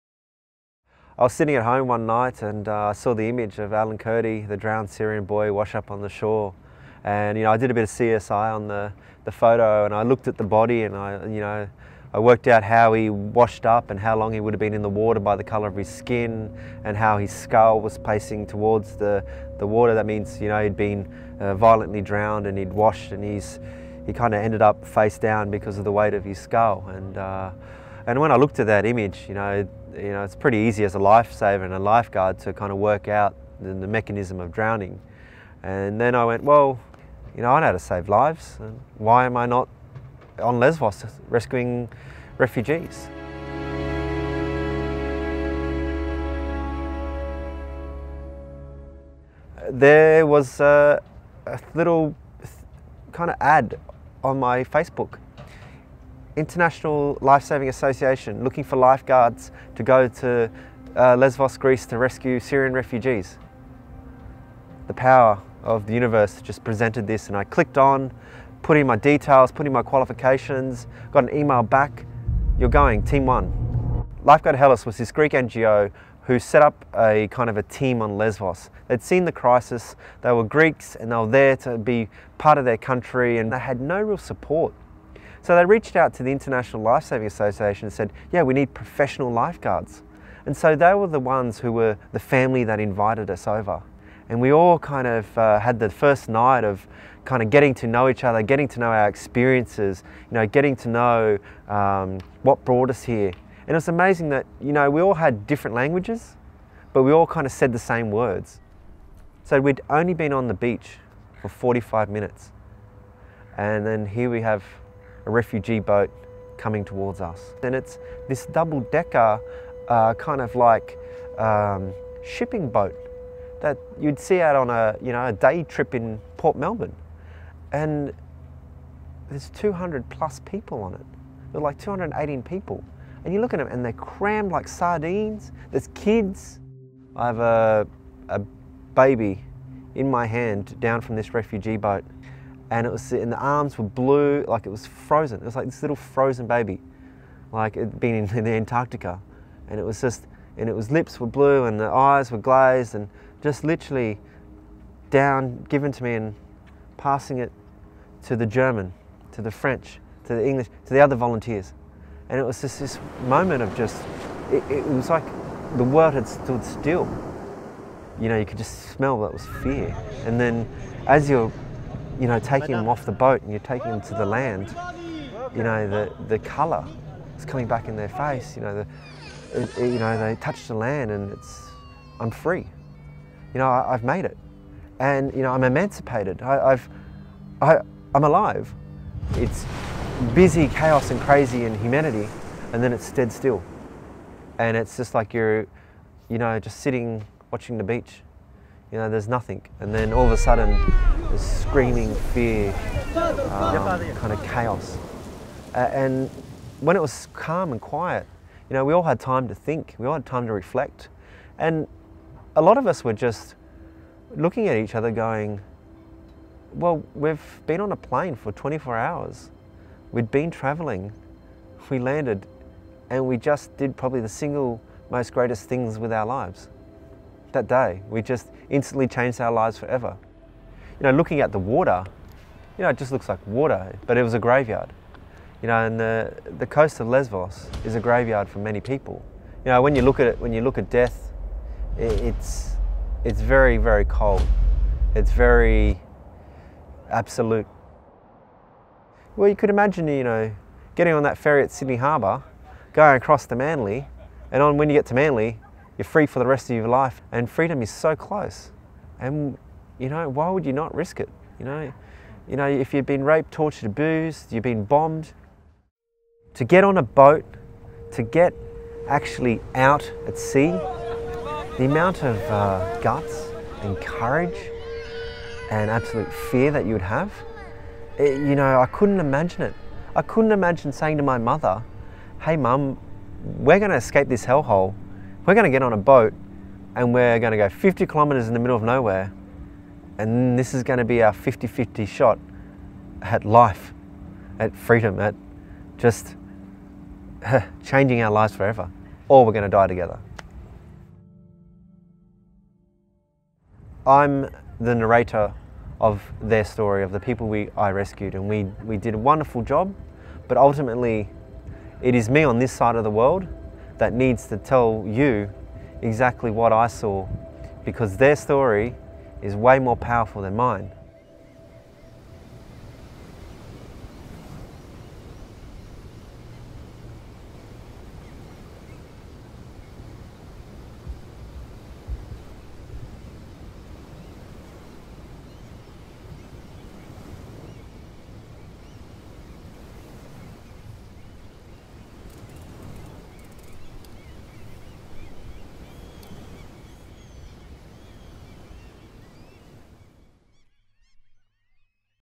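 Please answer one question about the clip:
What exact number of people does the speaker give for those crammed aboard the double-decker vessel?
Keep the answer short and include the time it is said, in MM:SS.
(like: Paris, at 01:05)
218, at 02:11.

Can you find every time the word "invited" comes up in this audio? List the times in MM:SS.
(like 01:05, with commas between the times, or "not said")
01:32.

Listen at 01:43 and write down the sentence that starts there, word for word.
And it's amazing that, you know, we all had different languages, but we all kind of said the same words.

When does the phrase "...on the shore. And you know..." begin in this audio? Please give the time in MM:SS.
00:05.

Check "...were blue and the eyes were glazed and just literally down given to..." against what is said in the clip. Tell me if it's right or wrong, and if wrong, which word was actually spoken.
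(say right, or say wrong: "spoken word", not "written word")
right.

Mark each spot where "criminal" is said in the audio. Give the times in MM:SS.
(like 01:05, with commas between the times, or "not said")
not said.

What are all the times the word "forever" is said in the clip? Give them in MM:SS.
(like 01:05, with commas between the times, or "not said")
03:49, 04:58.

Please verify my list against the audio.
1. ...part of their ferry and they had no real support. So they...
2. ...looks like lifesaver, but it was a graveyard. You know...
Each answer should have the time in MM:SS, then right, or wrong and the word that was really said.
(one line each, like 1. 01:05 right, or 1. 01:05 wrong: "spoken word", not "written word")
1. 01:22 wrong: "country", not "ferry"
2. 03:53 wrong: "water", not "lifesaver".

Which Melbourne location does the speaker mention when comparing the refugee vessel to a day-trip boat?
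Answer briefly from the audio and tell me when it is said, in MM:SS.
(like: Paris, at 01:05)
Port Melbourne, at 02:06.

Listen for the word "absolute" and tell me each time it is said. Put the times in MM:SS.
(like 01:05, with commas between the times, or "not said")
04:07, 04:35.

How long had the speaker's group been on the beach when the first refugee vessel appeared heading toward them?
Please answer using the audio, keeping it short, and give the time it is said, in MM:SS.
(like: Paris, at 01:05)
45 minutes, at 01:51.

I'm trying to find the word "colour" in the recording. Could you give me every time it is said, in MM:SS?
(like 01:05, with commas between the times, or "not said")
00:15, 02:56.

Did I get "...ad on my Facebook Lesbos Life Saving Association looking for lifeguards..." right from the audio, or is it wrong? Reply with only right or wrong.
wrong.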